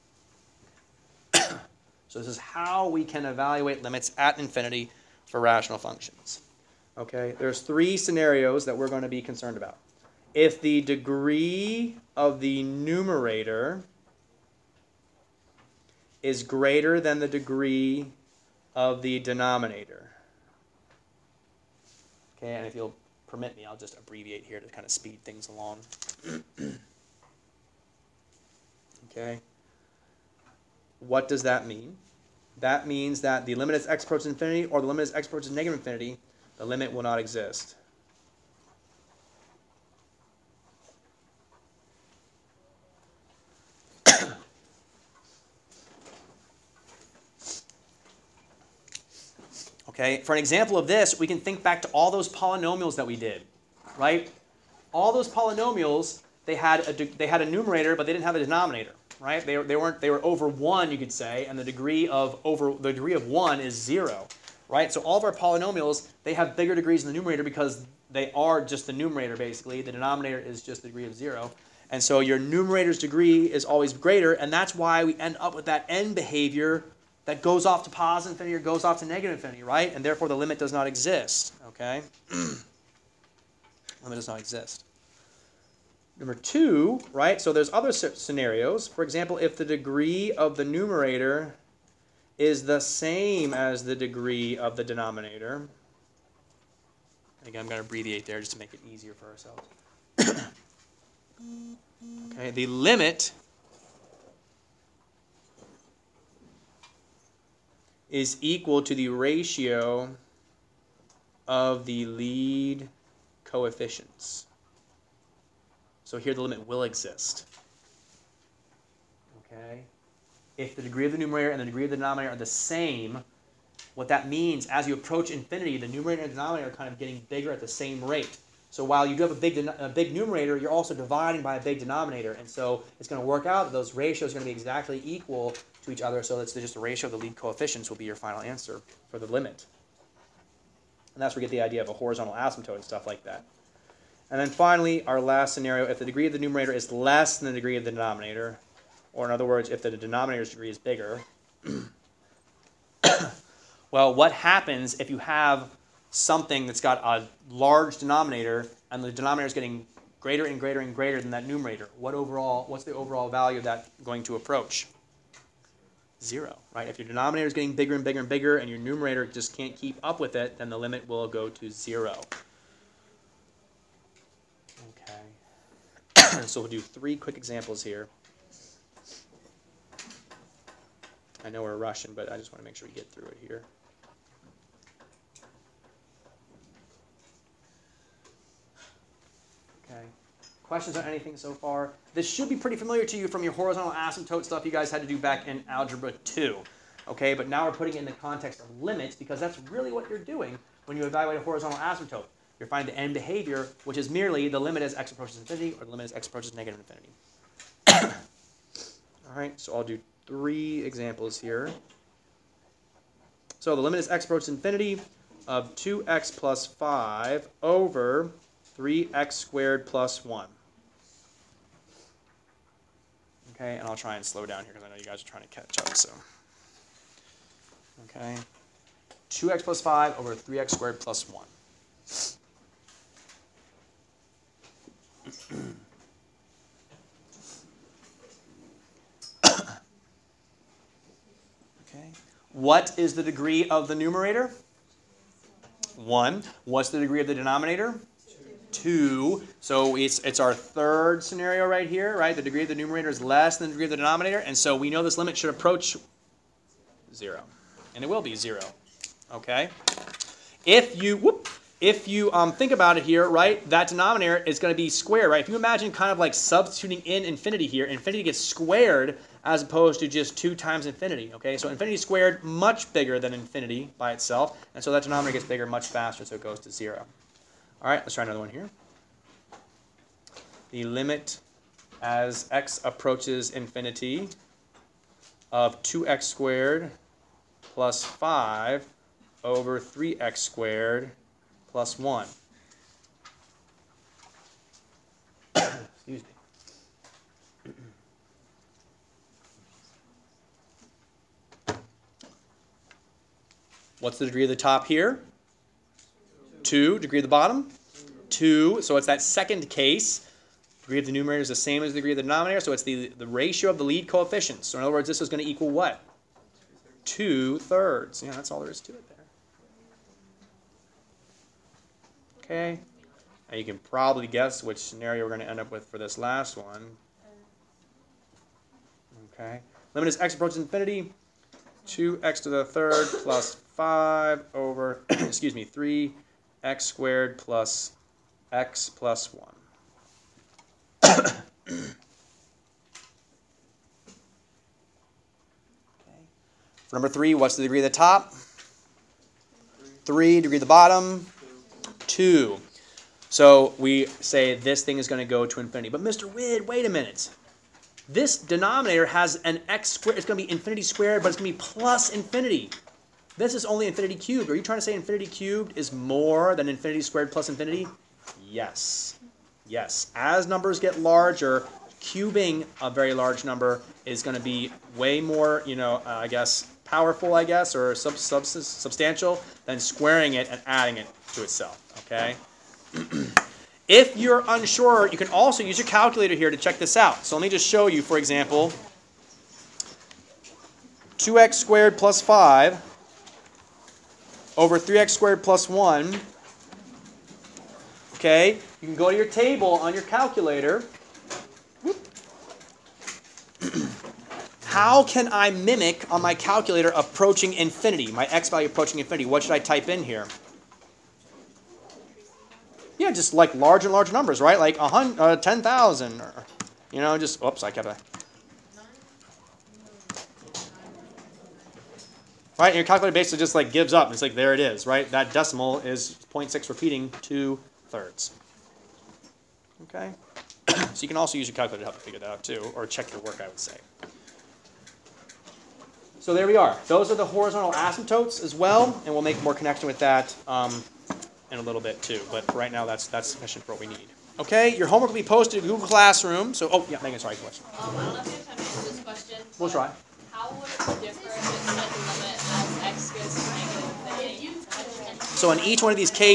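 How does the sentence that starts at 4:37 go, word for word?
All right, let's try another one here.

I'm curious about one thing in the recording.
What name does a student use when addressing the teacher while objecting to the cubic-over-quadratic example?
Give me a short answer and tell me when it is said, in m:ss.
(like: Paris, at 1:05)
Mr. Wid, at 5:56.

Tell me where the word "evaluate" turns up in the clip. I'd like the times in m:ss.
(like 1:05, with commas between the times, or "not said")
0:03, 3:21.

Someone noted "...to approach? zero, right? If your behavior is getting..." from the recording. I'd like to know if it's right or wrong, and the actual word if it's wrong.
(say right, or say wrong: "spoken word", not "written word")
wrong: "denominator", not "behavior".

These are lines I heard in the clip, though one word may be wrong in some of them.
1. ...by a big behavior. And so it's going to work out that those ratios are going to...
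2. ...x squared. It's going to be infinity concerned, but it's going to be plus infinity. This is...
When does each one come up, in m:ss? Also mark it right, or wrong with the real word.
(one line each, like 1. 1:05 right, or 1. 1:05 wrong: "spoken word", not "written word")
1. 2:11 wrong: "denominator", not "behavior"
2. 5:59 wrong: "squared", not "concerned".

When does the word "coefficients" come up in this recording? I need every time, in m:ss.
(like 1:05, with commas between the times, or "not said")
1:53, 2:17, 5:14.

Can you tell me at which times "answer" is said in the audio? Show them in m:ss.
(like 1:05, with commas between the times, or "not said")
2:18, 7:28.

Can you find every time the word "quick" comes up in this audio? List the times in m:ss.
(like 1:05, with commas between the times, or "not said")
2:57.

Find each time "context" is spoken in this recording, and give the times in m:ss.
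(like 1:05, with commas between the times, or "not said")
3:18.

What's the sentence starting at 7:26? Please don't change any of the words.
So, oh yeah, Megan, sorry, question.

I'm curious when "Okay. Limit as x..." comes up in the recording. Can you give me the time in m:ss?
5:29.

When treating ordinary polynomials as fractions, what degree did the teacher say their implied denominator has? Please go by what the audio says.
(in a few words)
0.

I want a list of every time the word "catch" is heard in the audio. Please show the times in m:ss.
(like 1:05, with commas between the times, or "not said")
3:45.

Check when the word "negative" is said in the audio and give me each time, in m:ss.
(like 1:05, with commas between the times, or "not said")
0:35, 1:19, 3:26.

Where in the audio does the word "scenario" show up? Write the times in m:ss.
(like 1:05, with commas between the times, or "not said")
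0:07, 1:27, 2:25, 4:11, 5:24.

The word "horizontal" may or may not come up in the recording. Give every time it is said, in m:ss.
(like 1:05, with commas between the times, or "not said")
2:21, 3:13, 3:21, 7:17.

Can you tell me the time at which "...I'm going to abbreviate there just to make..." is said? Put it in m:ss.
1:37.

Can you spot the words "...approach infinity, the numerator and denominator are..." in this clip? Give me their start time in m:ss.
2:04.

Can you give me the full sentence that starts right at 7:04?
It's like, there it is, right?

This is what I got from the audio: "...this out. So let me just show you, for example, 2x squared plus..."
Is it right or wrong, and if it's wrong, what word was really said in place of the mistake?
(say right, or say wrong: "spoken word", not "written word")
right.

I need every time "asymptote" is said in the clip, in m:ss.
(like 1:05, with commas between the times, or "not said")
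2:22, 3:13, 3:21, 7:17.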